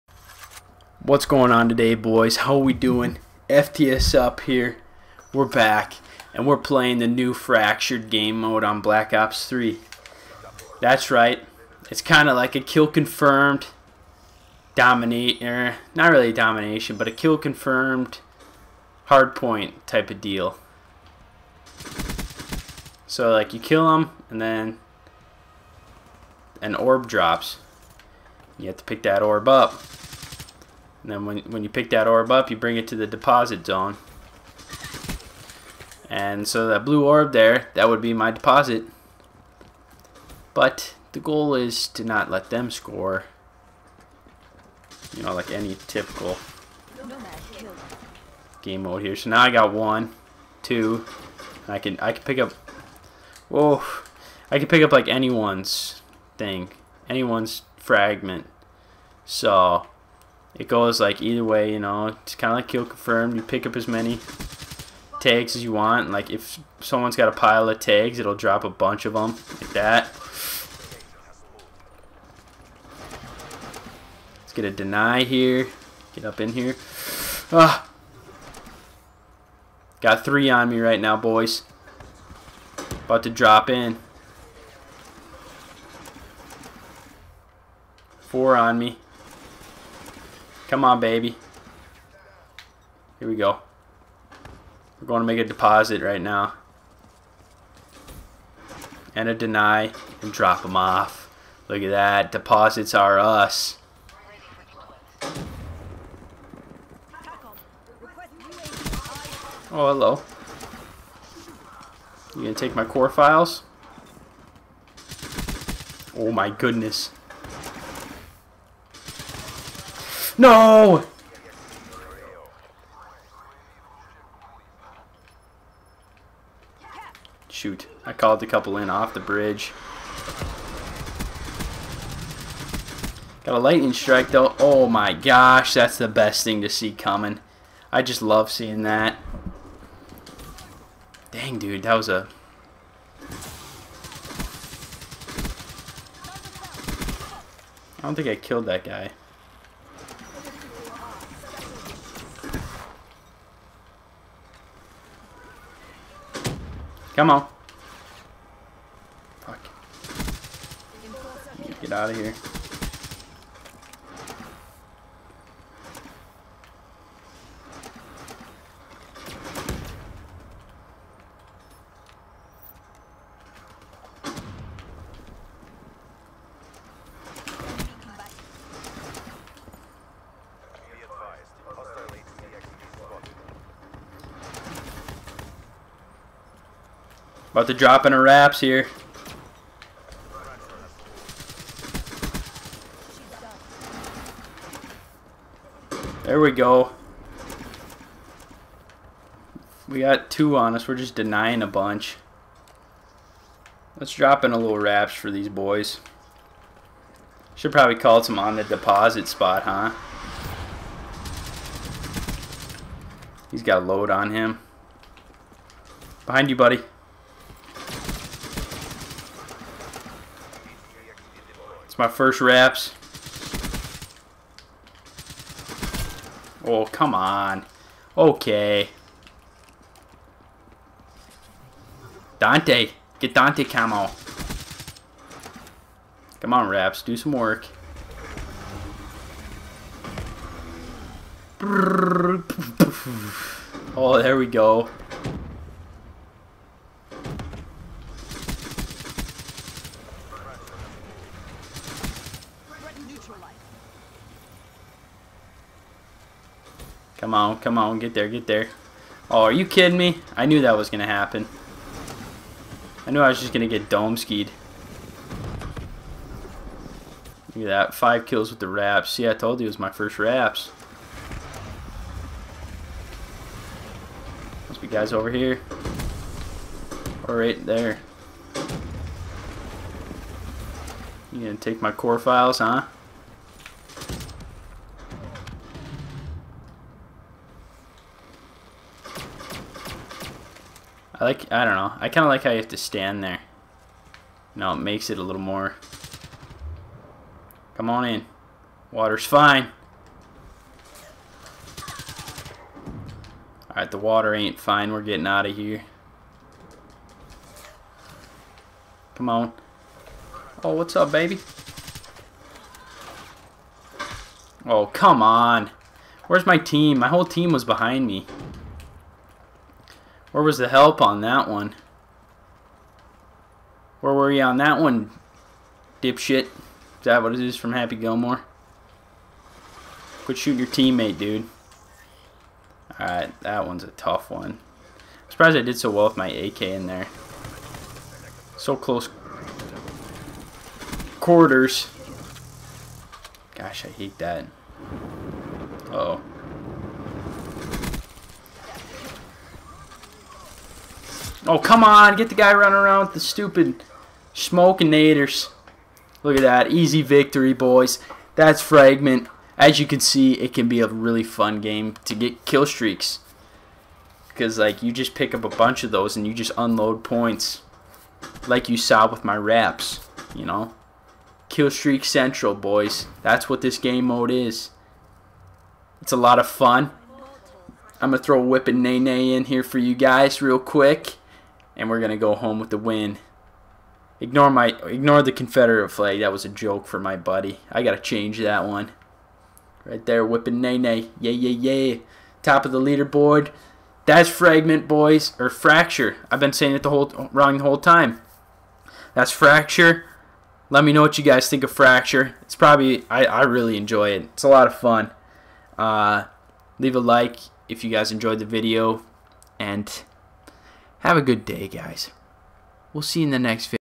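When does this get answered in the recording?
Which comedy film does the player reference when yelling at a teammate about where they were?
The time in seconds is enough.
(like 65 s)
327 s.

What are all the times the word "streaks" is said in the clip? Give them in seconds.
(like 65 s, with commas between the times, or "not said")
362 s, 371 s.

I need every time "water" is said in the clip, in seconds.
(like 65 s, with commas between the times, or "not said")
298 s, 303 s.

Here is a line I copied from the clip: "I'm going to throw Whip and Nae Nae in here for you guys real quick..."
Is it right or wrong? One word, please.
right.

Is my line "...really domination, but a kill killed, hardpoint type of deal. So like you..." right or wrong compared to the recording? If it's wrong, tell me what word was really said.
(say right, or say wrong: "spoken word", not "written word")
wrong: "confirmed", not "killed".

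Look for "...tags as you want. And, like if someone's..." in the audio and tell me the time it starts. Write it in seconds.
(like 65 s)
65 s.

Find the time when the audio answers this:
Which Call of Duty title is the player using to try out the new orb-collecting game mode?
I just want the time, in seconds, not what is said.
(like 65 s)
8 s.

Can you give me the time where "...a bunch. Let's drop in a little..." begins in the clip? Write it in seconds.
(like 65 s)
201 s.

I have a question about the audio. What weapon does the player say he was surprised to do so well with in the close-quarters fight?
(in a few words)
AK.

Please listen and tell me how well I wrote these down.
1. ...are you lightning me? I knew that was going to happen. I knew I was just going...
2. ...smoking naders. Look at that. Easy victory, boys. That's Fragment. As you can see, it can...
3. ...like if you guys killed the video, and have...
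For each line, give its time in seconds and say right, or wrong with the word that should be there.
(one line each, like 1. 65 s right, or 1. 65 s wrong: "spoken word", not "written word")
1. 259 s wrong: "kidding", not "lightning"
2. 354 s right
3. 406 s wrong: "enjoyed", not "killed".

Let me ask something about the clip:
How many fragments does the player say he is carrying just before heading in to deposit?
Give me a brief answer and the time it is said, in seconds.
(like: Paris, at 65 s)
4, at 88 s.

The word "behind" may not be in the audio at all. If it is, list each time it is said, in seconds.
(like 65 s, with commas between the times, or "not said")
216 s, 317 s.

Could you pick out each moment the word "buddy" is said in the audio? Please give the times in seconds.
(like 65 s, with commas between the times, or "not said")
216 s, 387 s.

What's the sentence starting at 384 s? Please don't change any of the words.
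Ignore my ignore the Confederate flag.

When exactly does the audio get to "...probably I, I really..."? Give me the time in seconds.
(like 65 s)
402 s.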